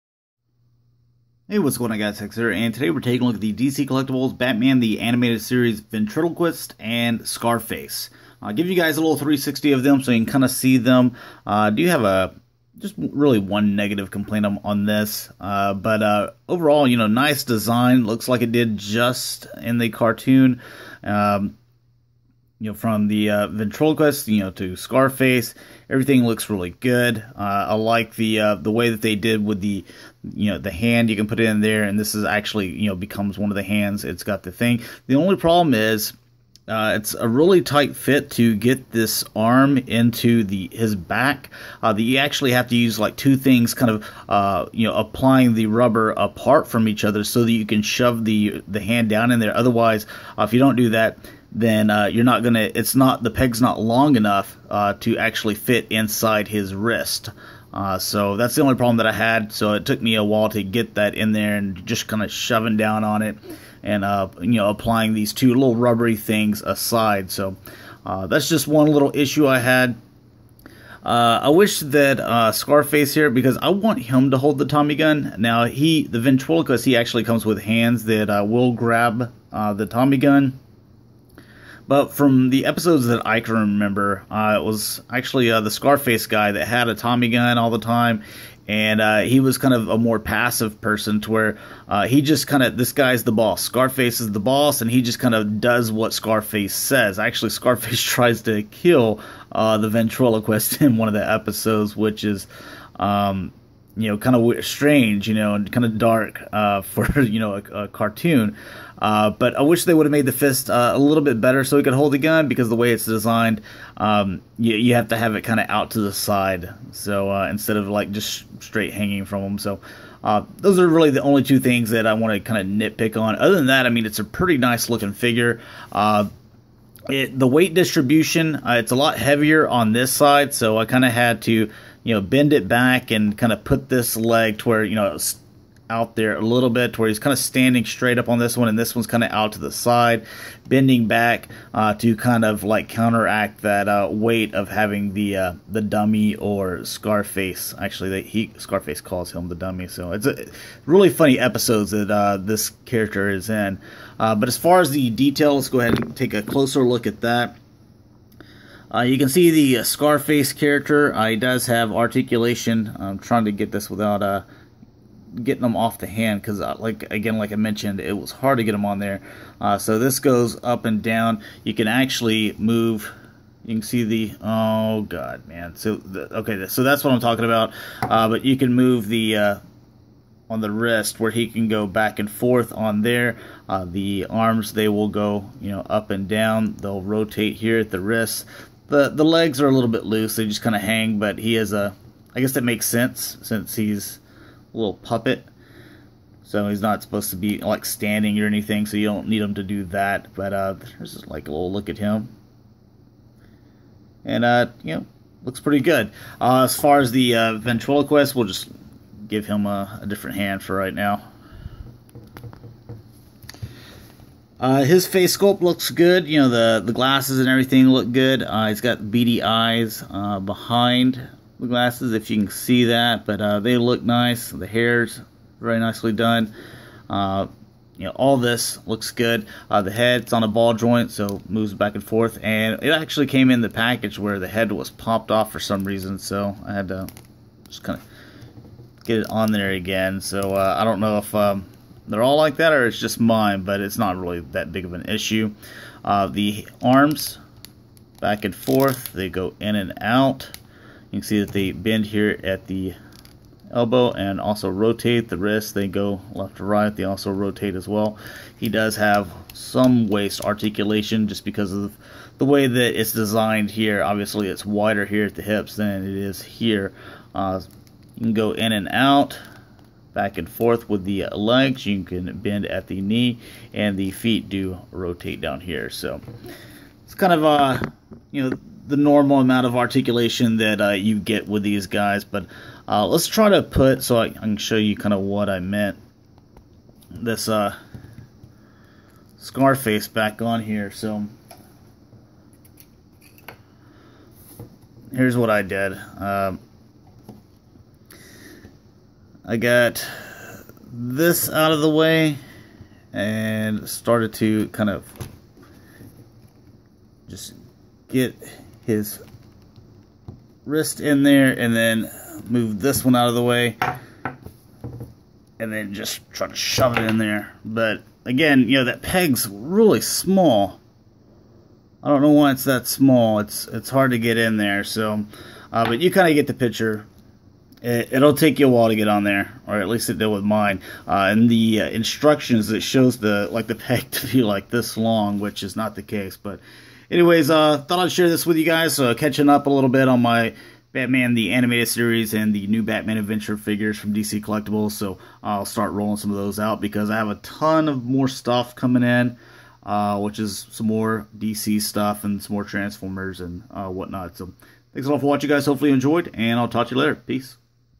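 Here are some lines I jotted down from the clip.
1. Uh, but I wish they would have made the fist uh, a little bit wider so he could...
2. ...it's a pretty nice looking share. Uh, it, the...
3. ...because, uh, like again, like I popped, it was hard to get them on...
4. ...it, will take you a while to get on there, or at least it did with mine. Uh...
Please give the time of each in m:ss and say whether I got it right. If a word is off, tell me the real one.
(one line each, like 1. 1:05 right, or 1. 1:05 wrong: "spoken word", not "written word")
1. 1:48 wrong: "better", not "wider"
2. 2:04 wrong: "figure", not "share"
3. 2:46 wrong: "mentioned", not "popped"
4. 5:27 right.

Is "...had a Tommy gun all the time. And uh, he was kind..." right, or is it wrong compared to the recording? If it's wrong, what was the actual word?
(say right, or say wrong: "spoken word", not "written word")
right.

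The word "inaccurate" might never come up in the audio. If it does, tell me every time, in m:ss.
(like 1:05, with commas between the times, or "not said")
not said.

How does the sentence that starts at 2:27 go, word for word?
Actually, they, he Scarface calls him the dummy, so it's a, really funny episodes that uh, this character is in.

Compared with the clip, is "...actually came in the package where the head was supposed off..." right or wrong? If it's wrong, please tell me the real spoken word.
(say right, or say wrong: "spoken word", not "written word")
wrong: "popped", not "supposed".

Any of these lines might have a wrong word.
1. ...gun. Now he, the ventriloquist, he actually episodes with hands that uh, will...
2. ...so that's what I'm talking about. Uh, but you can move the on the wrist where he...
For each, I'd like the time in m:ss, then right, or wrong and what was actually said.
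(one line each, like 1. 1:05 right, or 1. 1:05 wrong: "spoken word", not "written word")
1. 1:14 wrong: "comes", not "episodes"
2. 2:56 right.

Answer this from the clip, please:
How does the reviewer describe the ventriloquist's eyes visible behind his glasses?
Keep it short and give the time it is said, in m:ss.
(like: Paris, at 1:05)
beady eyes, at 3:39.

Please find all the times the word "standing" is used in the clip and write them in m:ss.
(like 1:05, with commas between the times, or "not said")
2:17, 3:17.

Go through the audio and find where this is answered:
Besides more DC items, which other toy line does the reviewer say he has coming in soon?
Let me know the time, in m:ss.
5:52.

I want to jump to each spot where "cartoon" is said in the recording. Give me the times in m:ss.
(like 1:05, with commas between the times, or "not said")
0:19, 1:47.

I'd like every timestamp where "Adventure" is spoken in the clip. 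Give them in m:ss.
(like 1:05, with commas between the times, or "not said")
5:43.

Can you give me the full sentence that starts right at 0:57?
Uh, so that's the only problem that I had.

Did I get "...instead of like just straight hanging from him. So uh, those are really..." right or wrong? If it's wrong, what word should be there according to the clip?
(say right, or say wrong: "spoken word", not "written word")
right.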